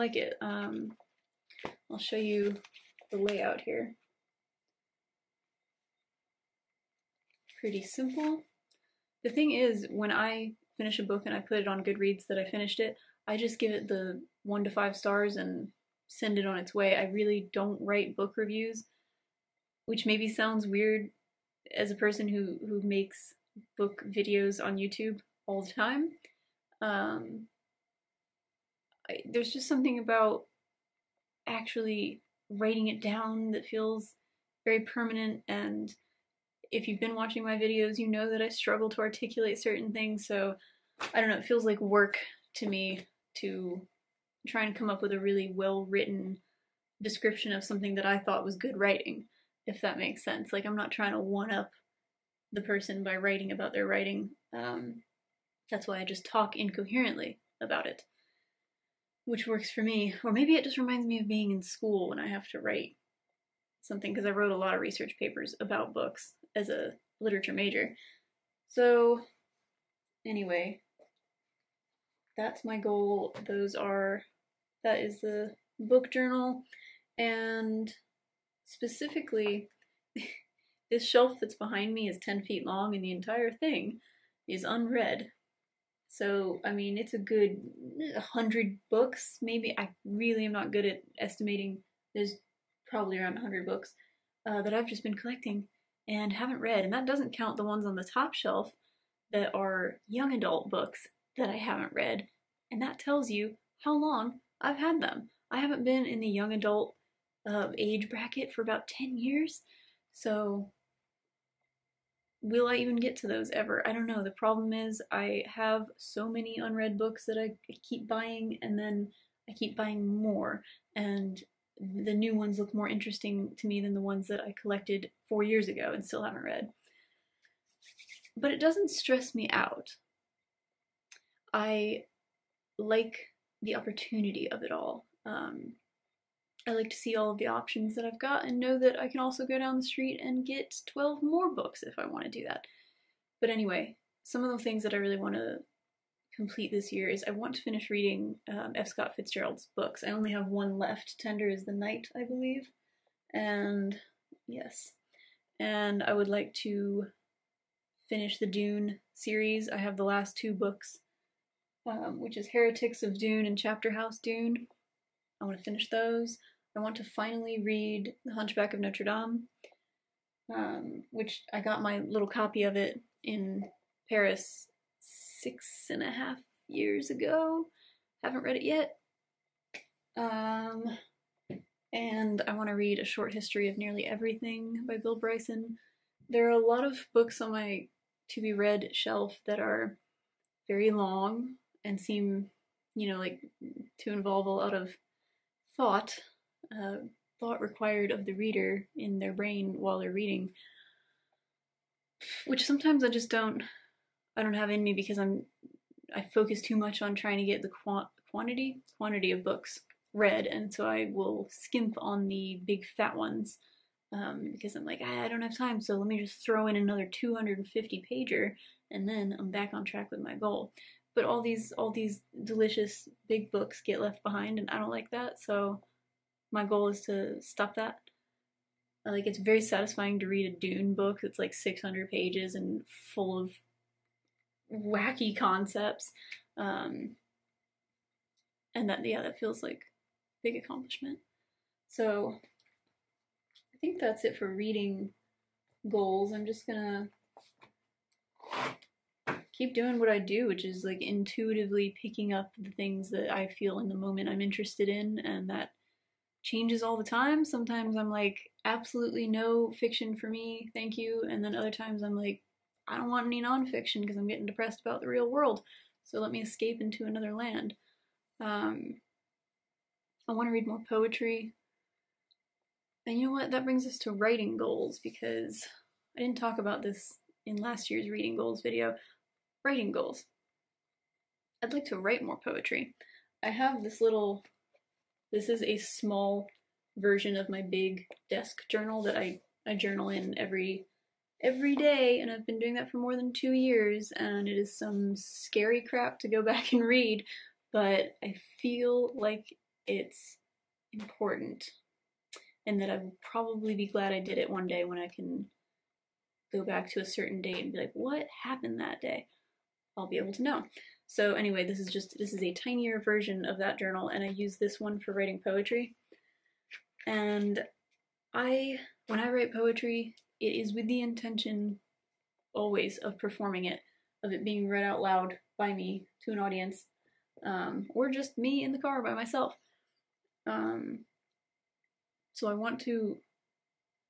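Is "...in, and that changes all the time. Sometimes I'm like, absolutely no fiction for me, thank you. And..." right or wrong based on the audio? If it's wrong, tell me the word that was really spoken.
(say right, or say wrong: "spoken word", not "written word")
right.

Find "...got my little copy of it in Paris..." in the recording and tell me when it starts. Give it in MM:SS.
02:51.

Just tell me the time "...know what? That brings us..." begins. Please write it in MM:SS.
04:33.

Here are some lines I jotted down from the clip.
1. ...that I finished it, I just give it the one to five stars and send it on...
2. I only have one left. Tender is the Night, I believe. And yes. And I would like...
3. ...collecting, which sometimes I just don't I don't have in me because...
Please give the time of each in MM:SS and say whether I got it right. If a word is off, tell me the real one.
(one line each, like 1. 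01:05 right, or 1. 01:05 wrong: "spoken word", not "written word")
1. 00:12 right
2. 02:30 right
3. 03:20 wrong: "reading", not "collecting".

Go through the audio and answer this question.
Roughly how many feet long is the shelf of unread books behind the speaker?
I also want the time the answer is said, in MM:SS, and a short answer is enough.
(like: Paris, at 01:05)
10, at 01:22.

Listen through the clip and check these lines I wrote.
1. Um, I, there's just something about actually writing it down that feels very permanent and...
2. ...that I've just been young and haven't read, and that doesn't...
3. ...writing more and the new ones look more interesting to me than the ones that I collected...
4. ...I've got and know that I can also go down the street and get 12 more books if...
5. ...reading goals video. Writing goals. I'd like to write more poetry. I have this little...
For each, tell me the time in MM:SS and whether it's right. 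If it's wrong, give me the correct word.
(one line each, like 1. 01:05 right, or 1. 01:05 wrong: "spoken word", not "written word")
1. 00:26 right
2. 01:34 wrong: "collecting", not "young"
3. 01:59 wrong: "buying", not "writing"
4. 02:18 right
5. 04:38 right.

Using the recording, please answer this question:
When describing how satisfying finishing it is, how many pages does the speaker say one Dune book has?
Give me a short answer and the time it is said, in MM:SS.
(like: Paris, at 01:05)
600, at 03:51.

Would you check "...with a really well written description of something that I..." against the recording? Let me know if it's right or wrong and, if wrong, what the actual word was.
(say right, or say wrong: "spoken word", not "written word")
right.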